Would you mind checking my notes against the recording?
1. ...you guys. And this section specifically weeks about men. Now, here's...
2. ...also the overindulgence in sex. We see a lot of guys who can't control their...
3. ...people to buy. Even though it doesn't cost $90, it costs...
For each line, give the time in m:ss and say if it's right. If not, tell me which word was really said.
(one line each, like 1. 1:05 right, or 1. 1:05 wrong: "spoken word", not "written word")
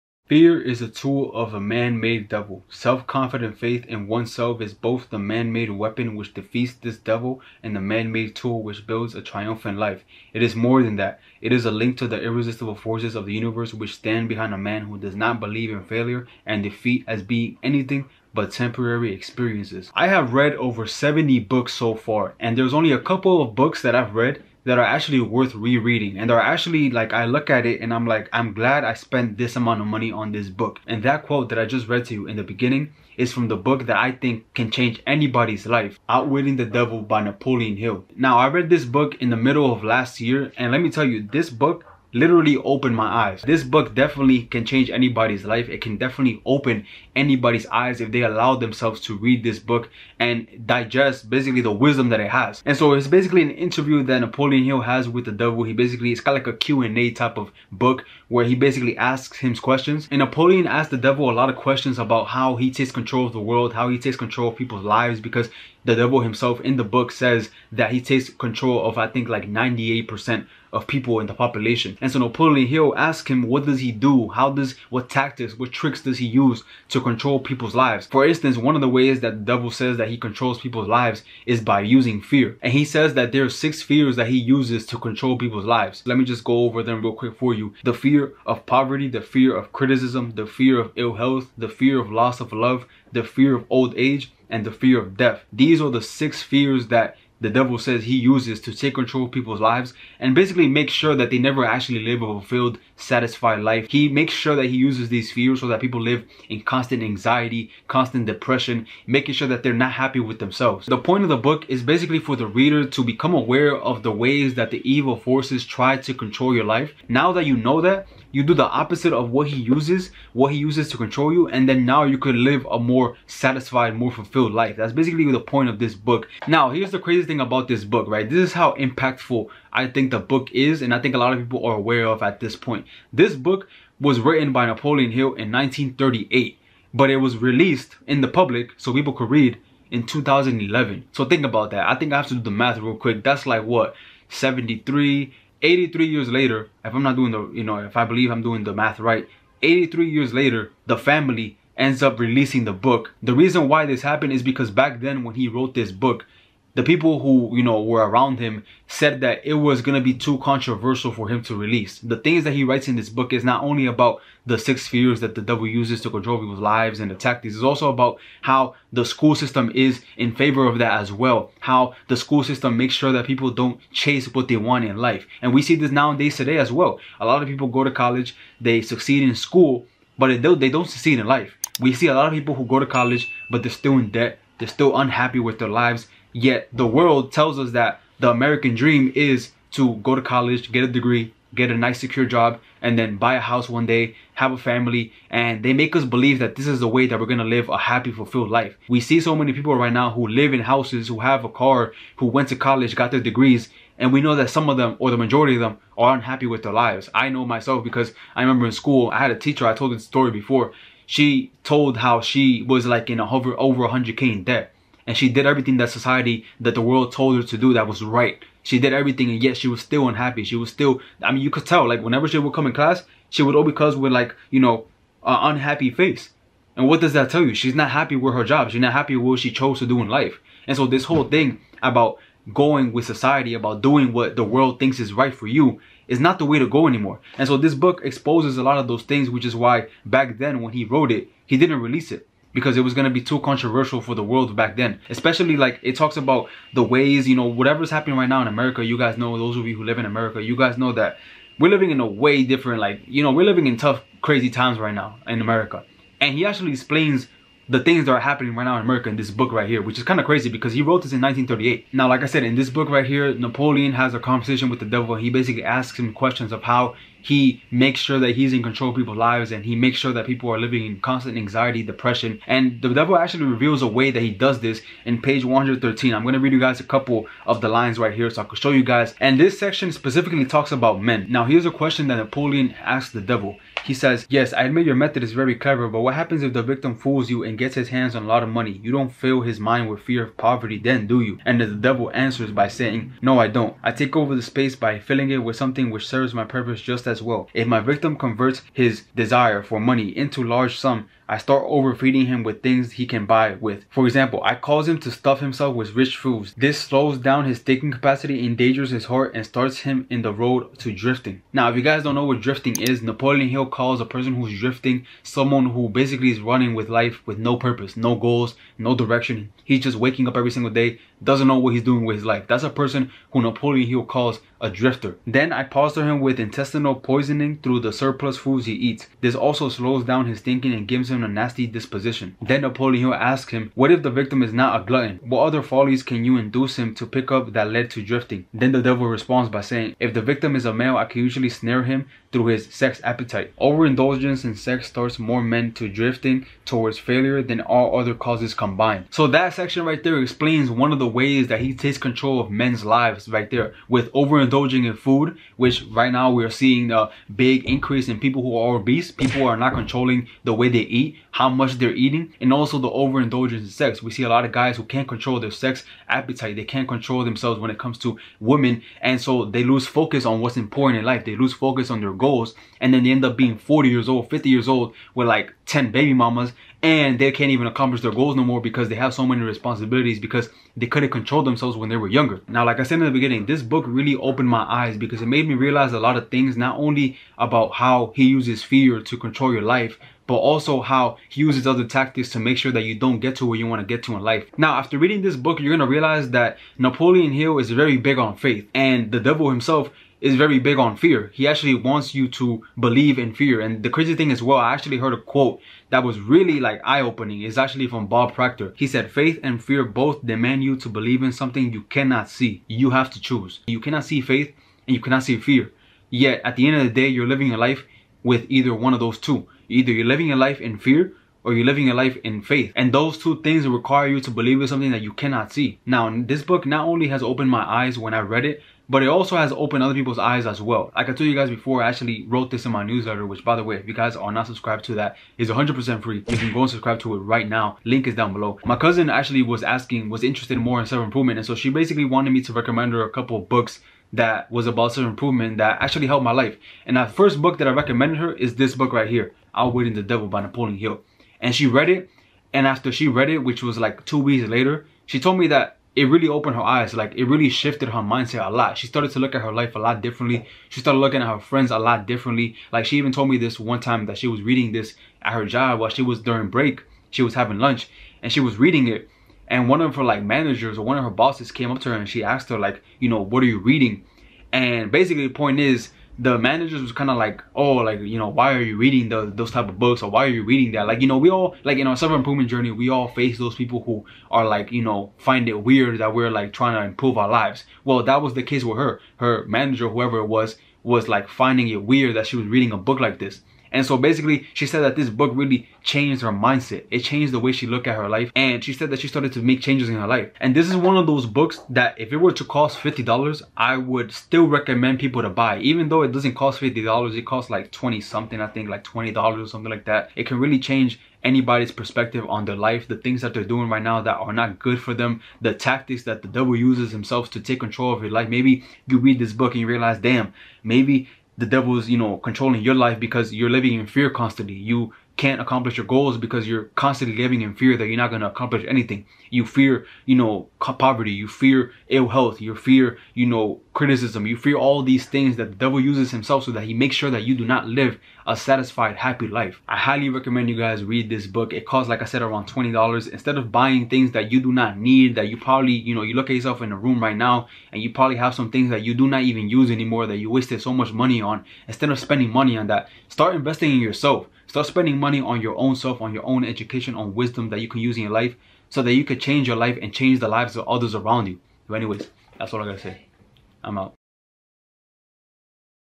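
1. 4:38 wrong: "talks", not "weeks"
2. 6:02 right
3. 8:24 wrong: "50", not "90".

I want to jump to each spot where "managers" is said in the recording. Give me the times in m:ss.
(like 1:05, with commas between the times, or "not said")
7:50, 7:56, 8:09.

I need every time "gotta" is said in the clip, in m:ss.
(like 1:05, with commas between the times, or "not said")
9:22.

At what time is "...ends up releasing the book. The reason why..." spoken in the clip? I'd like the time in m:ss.
2:31.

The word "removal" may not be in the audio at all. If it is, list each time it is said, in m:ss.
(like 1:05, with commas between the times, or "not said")
not said.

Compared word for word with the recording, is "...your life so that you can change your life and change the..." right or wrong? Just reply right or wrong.
right.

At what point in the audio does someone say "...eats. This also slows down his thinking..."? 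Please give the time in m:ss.
5:28.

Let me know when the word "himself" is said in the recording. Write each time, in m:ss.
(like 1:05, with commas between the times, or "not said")
1:06, 5:05, 6:39, 8:36, 8:56.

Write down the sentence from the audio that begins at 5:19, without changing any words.
He's just waking up every single day, doesn't know what he's doing with his life.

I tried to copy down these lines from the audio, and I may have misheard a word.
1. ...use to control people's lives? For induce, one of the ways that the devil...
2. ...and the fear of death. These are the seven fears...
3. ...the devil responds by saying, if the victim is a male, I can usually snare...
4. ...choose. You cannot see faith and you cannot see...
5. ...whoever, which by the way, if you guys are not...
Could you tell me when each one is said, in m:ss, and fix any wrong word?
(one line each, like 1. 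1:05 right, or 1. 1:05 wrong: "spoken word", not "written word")
1. 1:16 wrong: "instance", not "induce"
2. 1:34 wrong: "six", not "seven"
3. 5:38 right
4. 6:53 right
5. 7:12 wrong: "newsletter", not "whoever".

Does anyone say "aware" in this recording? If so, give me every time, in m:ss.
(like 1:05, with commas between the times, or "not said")
1:53, 2:11.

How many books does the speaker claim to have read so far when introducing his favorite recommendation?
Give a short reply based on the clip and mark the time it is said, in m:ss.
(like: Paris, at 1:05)
over 70, at 0:20.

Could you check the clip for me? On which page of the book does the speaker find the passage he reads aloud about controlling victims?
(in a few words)
113.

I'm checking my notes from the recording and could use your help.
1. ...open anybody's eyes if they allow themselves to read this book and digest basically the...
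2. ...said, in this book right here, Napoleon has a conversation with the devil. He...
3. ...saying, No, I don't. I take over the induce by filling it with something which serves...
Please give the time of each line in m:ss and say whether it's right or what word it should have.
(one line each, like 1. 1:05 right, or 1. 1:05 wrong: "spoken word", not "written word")
1. 0:46 right
2. 4:22 right
3. 4:52 wrong: "space", not "induce".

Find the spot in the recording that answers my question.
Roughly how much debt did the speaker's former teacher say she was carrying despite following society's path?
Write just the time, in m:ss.
3:33.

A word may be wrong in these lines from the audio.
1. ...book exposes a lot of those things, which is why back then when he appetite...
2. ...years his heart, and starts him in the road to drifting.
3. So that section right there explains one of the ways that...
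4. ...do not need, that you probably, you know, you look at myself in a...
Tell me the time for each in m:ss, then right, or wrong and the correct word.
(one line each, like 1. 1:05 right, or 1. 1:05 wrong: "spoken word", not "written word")
1. 3:57 wrong: "wrote", not "appetite"
2. 5:08 wrong: "endangers", not "years"
3. 5:49 right
4. 9:04 wrong: "yourself", not "myself".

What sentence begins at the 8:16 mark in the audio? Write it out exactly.
It changed the way she looked at her life.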